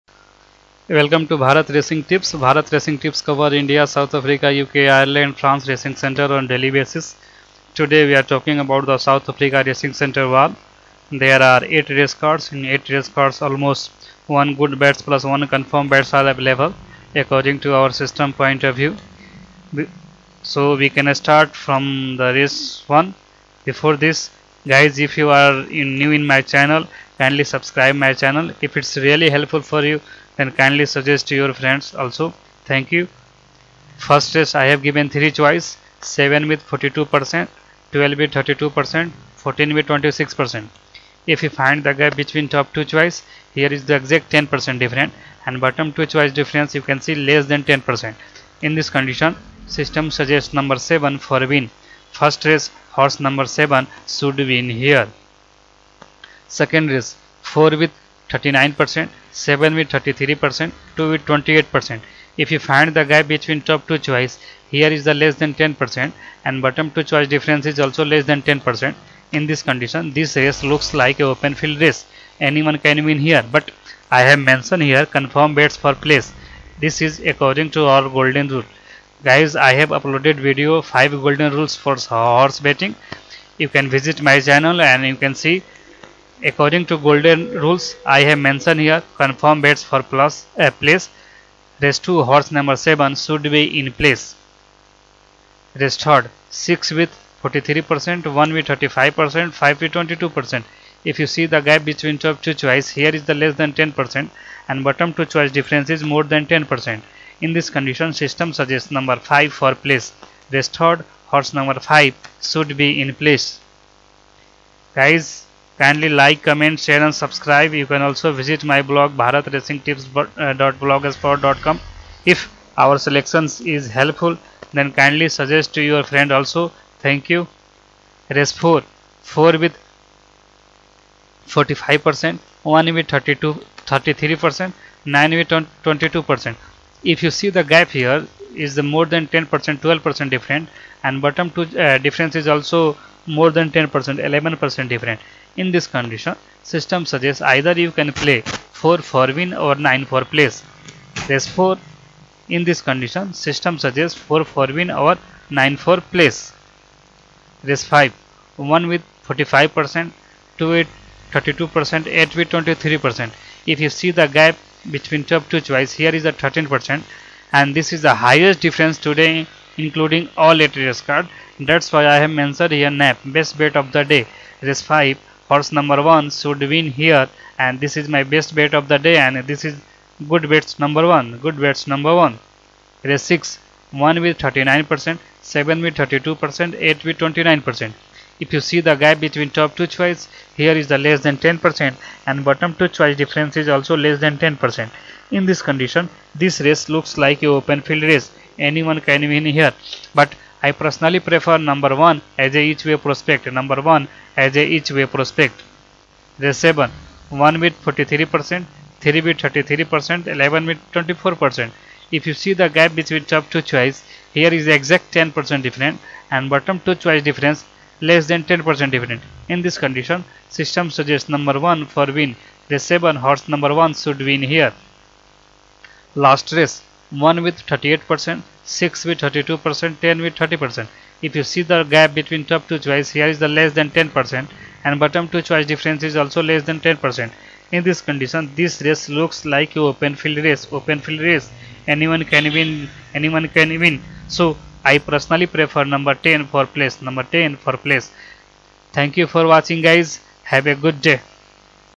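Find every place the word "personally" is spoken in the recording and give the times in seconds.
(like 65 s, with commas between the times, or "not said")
200 s, 244 s.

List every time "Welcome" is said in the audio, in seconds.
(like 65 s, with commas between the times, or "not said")
0 s.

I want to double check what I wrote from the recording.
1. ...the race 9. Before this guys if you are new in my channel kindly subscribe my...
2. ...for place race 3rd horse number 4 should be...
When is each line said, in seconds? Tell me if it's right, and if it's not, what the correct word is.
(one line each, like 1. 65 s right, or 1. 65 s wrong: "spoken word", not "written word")
1. 22 s wrong: "1", not "9"
2. 109 s wrong: "5", not "4".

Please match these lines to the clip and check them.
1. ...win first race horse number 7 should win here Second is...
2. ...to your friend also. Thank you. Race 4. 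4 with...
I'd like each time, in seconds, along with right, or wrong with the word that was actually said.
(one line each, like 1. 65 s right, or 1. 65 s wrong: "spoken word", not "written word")
1. 51 s right
2. 125 s right.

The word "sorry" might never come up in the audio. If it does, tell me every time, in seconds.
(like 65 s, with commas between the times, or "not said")
not said.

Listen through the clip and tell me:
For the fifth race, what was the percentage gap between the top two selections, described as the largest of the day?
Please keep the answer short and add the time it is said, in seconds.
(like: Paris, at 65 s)
13%, at 166 s.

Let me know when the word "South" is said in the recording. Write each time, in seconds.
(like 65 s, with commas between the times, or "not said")
3 s, 8 s.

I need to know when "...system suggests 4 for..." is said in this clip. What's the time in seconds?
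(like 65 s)
153 s.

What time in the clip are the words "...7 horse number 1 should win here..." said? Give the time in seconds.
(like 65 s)
223 s.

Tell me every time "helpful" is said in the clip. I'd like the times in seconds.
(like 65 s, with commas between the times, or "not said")
29 s, 123 s.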